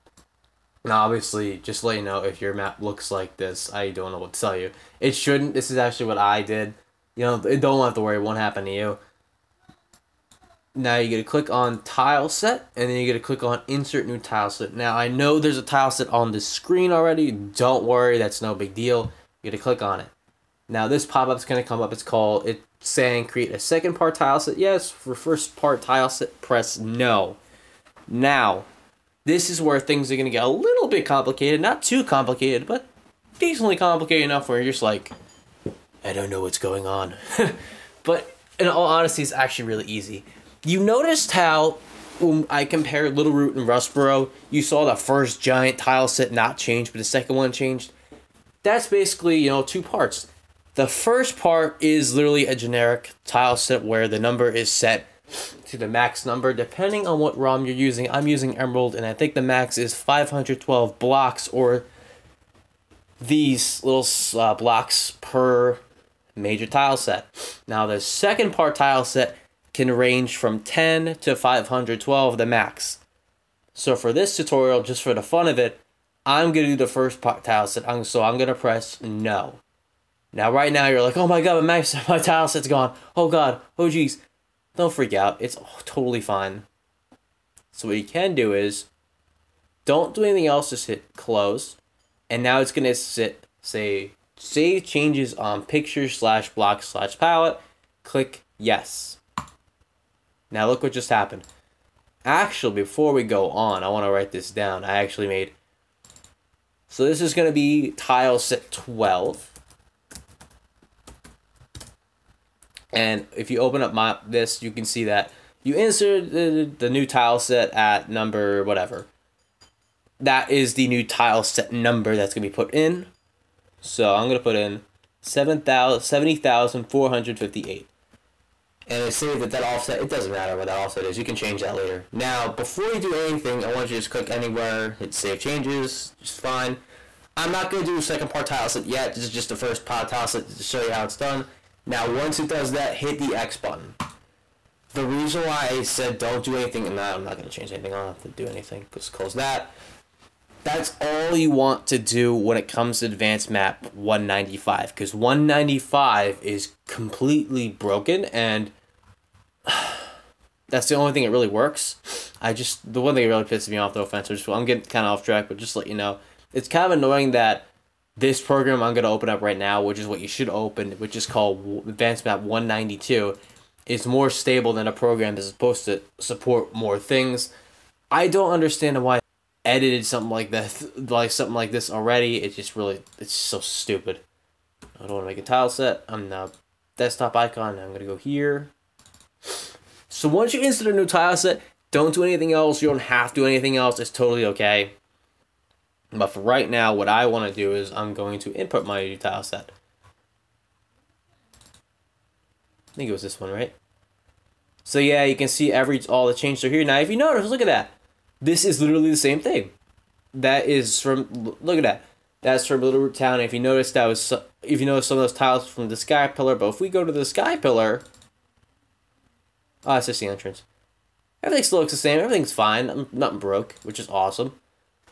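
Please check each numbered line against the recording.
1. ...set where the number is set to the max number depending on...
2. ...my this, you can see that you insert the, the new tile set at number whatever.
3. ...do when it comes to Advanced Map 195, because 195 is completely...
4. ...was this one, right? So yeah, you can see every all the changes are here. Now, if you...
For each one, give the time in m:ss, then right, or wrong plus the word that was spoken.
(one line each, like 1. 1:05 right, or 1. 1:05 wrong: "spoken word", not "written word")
1. 0:53 right
2. 1:53 right
3. 2:31 right
4. 3:23 right.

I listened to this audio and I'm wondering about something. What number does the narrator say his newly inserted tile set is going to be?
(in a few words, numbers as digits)
12.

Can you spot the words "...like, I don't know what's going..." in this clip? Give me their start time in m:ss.
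0:34.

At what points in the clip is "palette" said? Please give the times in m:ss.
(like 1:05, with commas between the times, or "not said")
1:37.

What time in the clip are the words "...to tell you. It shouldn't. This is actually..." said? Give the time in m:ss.
0:04.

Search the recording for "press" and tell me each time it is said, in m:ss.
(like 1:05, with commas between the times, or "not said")
0:26, 1:18.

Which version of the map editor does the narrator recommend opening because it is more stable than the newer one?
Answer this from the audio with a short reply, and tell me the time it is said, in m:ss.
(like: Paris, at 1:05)
Advanced Map 192, at 2:51.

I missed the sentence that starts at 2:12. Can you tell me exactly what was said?
Now, before you do anything, I want you to just click anywhere.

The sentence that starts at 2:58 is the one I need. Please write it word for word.
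I don't understand why I edited something like this, like something like this already.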